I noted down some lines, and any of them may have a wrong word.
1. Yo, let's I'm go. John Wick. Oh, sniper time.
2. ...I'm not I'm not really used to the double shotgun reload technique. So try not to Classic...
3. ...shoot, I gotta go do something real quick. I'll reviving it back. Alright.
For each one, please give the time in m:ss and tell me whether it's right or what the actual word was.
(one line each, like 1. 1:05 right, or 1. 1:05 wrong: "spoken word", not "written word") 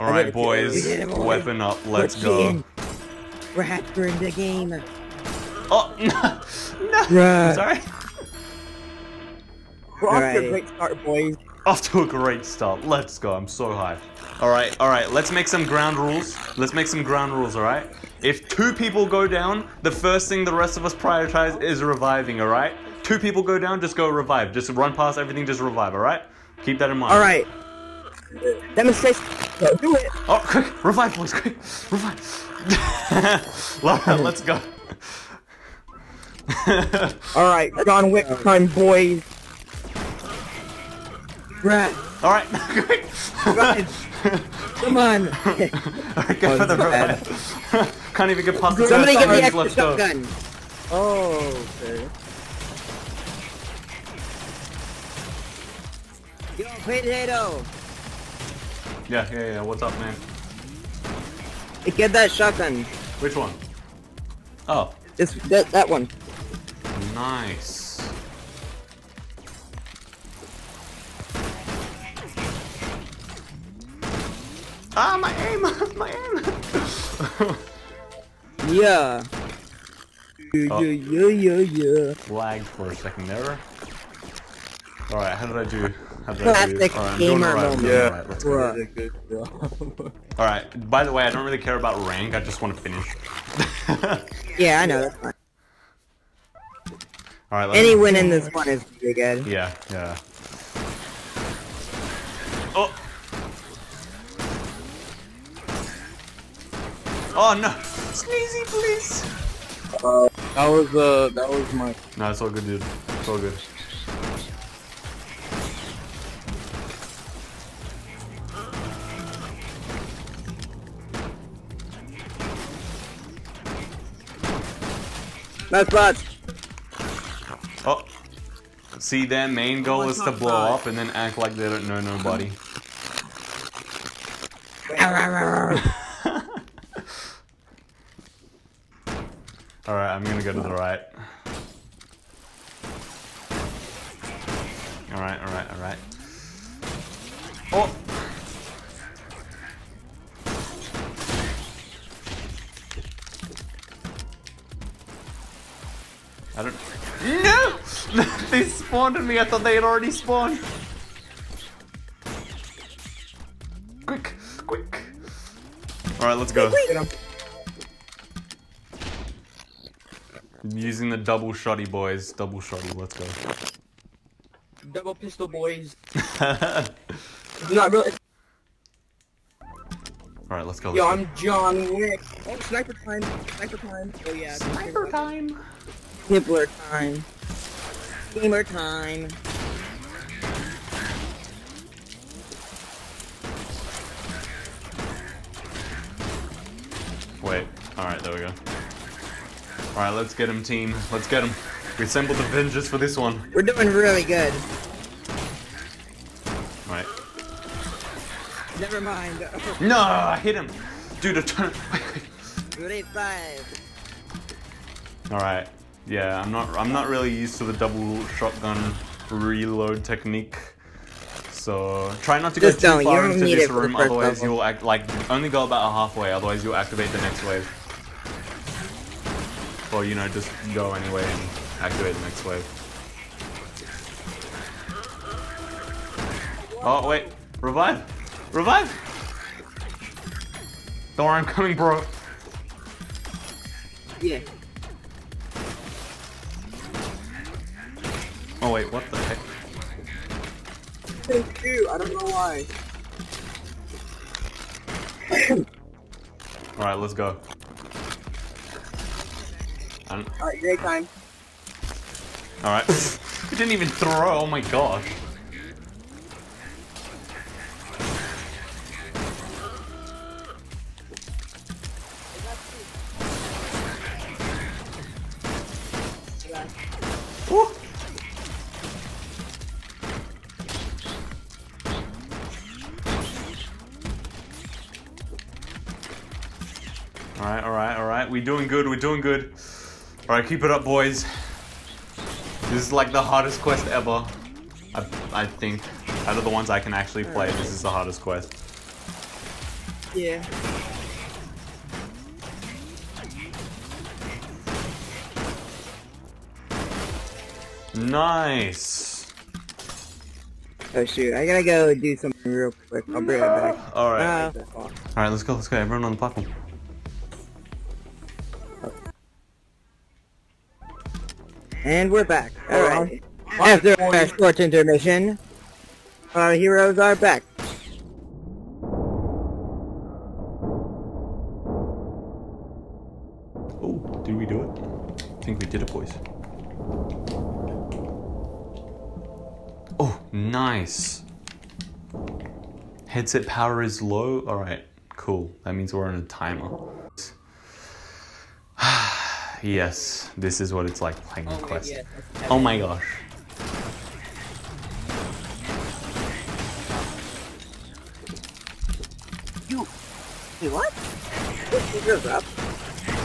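1. 3:00 right
2. 3:36 wrong: "Just", not "Classic"
3. 5:11 wrong: "bring", not "reviving".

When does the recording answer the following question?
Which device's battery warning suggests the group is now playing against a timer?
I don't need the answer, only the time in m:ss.
5:43.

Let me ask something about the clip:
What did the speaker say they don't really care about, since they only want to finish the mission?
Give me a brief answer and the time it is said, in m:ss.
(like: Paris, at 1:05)
rank, at 1:32.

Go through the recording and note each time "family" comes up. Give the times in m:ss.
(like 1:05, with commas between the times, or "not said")
not said.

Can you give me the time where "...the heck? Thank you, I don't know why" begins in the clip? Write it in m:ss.
4:09.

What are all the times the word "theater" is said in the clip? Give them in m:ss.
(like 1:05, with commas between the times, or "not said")
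not said.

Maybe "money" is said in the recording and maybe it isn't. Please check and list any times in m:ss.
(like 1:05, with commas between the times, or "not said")
not said.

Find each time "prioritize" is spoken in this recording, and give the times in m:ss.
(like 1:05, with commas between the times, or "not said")
0:20.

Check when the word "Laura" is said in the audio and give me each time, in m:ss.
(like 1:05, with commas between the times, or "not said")
0:33.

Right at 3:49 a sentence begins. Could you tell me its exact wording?
Well, you know, just go anyway and activate the next wave.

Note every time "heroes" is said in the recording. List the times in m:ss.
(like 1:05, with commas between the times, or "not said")
5:26.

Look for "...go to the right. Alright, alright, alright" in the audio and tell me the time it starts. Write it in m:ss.
2:20.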